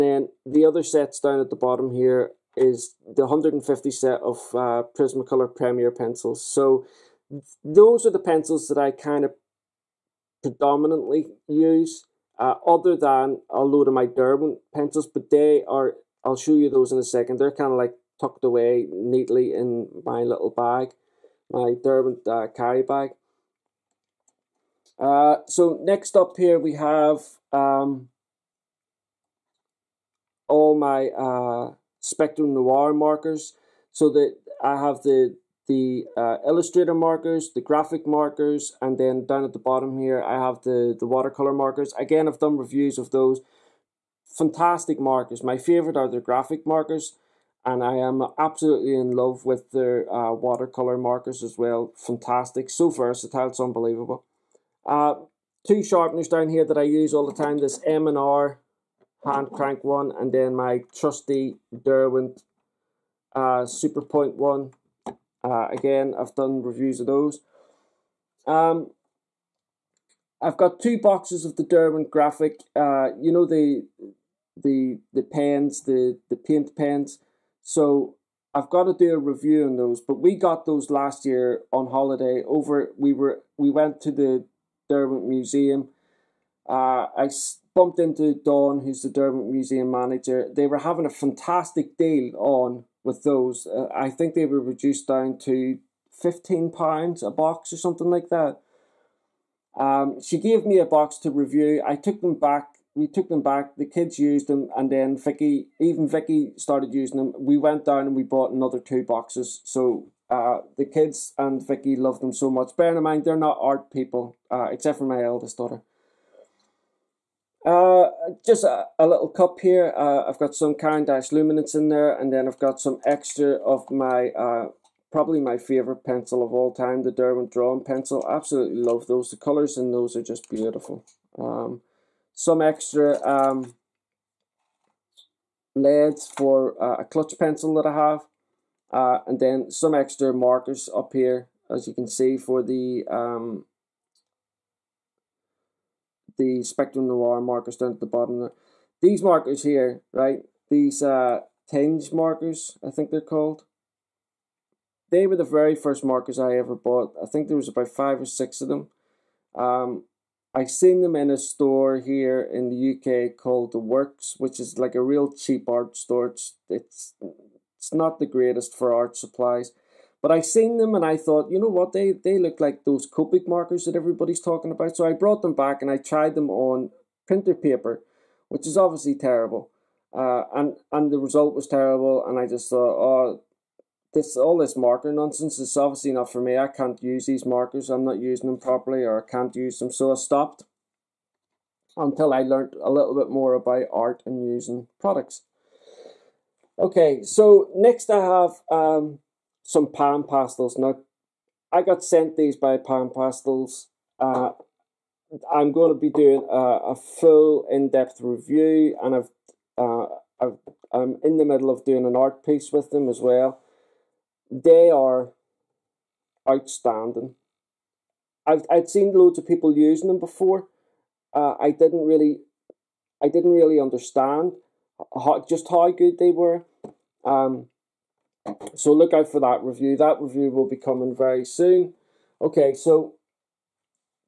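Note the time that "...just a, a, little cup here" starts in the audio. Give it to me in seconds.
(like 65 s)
118 s.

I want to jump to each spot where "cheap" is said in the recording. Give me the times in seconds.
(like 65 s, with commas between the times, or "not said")
165 s.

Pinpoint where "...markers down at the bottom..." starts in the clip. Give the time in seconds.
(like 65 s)
147 s.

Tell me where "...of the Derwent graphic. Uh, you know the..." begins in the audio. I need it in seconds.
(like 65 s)
71 s.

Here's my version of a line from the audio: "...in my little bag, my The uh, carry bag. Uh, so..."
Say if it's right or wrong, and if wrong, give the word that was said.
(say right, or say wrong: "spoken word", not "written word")
wrong: "Derwent", not "The".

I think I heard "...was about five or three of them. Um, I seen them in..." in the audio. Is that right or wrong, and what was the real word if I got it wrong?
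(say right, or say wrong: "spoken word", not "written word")
wrong: "six", not "three".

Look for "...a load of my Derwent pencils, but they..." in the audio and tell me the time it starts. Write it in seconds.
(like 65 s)
13 s.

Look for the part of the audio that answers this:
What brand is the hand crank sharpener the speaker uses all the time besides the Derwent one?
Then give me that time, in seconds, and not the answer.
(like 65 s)
57 s.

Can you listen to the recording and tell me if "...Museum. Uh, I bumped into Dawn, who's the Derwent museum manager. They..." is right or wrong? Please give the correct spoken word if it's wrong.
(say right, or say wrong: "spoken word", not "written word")
right.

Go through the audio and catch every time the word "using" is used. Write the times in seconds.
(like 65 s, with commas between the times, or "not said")
106 s, 188 s, 194 s, 219 s.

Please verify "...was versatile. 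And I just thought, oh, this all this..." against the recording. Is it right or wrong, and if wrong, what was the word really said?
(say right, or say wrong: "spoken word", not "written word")
wrong: "terrible", not "versatile".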